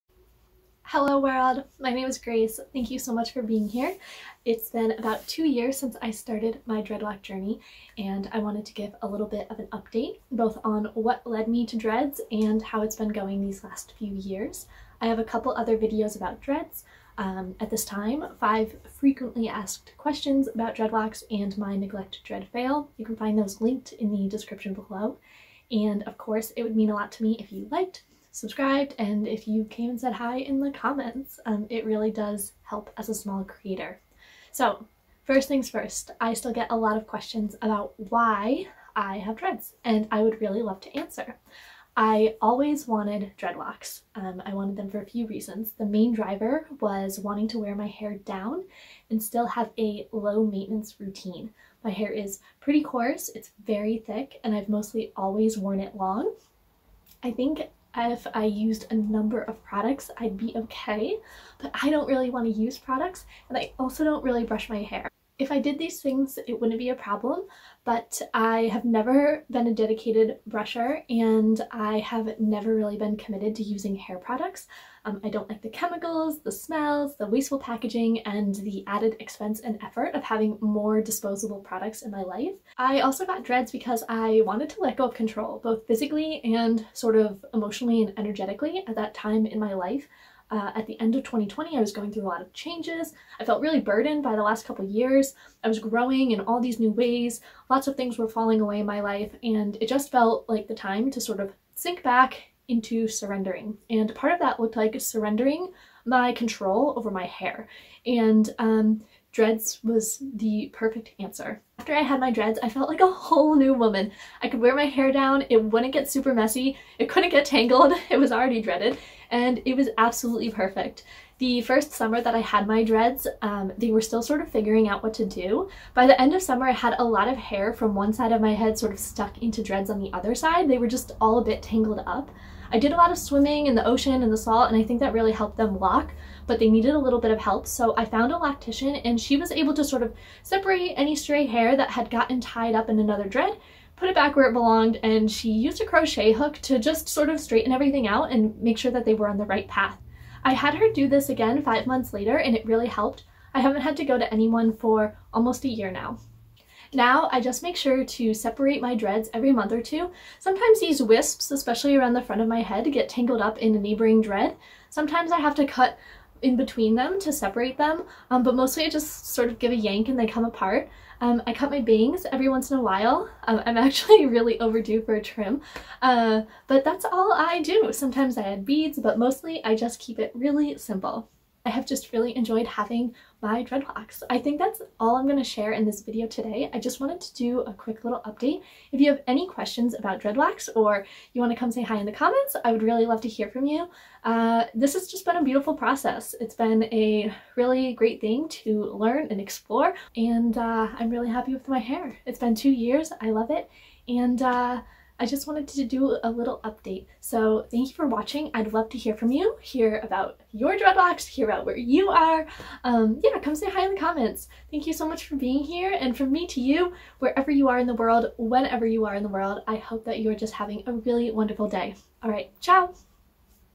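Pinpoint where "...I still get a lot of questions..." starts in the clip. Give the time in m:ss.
0:36.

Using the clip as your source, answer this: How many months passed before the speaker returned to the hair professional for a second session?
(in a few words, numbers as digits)
5.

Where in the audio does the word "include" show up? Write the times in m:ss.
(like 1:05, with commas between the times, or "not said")
not said.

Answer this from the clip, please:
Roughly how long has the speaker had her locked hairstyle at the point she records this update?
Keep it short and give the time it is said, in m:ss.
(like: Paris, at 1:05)
2 years, at 0:04.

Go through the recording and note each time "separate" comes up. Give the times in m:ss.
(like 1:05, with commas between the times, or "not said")
2:20, 2:38, 2:47.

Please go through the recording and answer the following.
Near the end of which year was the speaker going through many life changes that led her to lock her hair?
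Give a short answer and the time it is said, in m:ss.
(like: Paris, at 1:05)
2020, at 1:31.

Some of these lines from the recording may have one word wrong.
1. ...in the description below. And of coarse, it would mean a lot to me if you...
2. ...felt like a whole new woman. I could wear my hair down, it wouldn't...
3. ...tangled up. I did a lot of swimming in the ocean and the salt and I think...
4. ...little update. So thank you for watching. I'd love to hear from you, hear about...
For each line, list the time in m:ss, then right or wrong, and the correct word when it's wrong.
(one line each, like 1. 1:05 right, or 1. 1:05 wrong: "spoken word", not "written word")
1. 0:23 wrong: "course", not "coarse"
2. 1:52 right
3. 2:11 right
4. 3:26 right.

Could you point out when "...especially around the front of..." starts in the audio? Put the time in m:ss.
2:41.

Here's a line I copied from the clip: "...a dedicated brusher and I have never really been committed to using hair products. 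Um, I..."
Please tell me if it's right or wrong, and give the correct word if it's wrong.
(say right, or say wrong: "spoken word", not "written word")
right.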